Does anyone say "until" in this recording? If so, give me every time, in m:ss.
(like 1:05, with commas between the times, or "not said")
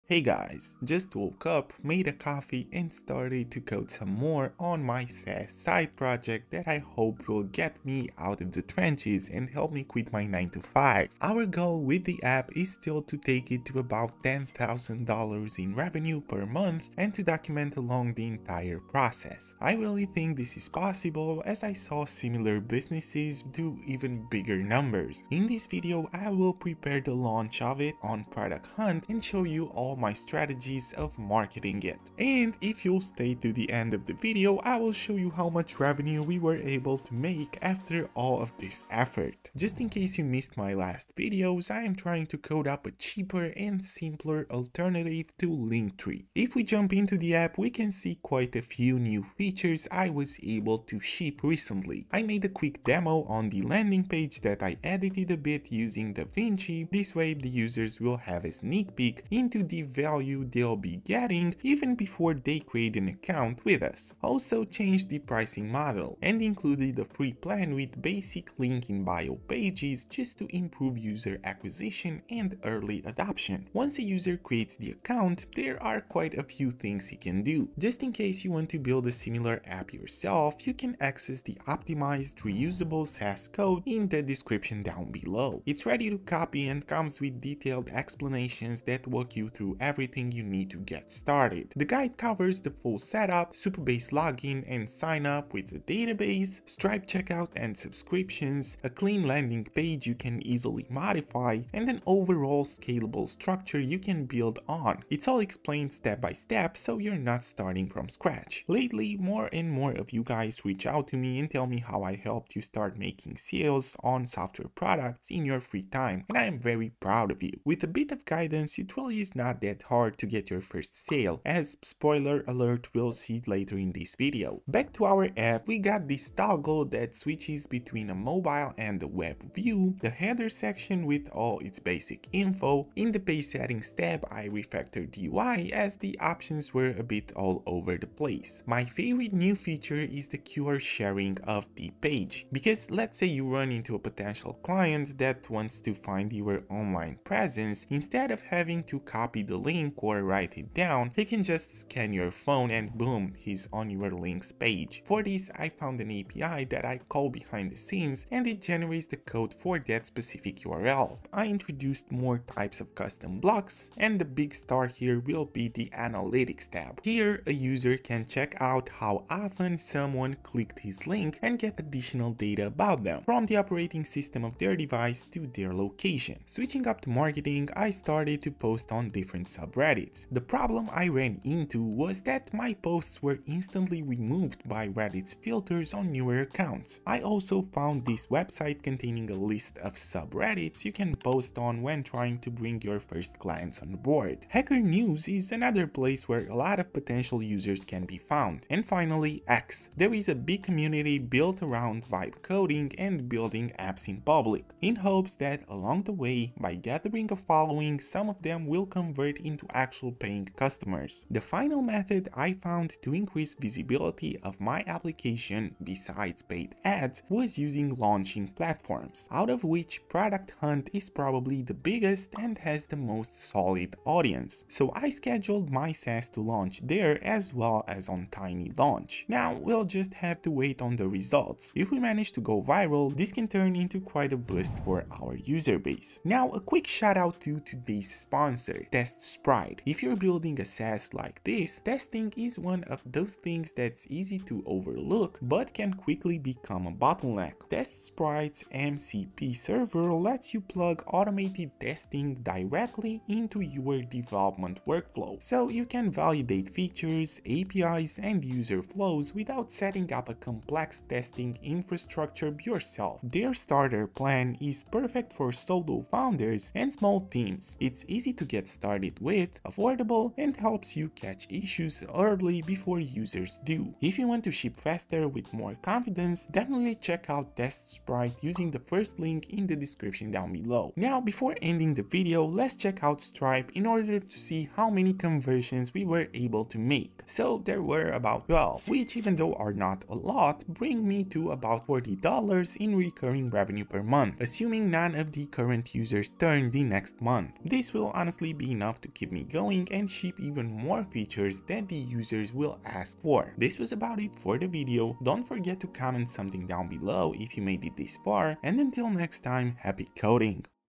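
5:08.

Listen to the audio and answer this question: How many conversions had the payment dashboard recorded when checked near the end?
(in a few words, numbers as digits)
12.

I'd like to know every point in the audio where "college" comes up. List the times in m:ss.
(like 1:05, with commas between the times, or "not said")
not said.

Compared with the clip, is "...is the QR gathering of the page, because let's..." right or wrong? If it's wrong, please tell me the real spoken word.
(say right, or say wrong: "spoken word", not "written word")
wrong: "sharing", not "gathering".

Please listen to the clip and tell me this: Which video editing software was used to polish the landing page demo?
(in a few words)
DaVinci.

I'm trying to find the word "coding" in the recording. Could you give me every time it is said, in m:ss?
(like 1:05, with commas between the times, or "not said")
3:22, 5:10.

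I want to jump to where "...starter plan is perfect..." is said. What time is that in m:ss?
4:23.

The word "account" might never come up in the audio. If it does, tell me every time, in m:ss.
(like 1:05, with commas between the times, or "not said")
1:03, 1:14, 3:06.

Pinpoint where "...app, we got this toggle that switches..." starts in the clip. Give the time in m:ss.
2:05.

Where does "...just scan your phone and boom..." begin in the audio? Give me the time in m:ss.
2:31.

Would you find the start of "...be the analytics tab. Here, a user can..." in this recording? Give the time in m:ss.
2:45.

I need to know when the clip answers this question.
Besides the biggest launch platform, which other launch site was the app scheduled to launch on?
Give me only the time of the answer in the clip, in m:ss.
3:48.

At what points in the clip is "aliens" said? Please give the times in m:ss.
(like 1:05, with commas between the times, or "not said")
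not said.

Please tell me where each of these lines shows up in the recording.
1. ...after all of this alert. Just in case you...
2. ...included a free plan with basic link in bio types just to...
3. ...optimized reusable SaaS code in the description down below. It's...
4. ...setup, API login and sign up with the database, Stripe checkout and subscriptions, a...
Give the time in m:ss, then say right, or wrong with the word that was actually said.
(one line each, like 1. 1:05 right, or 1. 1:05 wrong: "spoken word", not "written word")
1. 0:37 wrong: "effort", not "alert"
2. 1:06 wrong: "pages", not "types"
3. 1:21 right
4. 1:32 wrong: "Supabase", not "API".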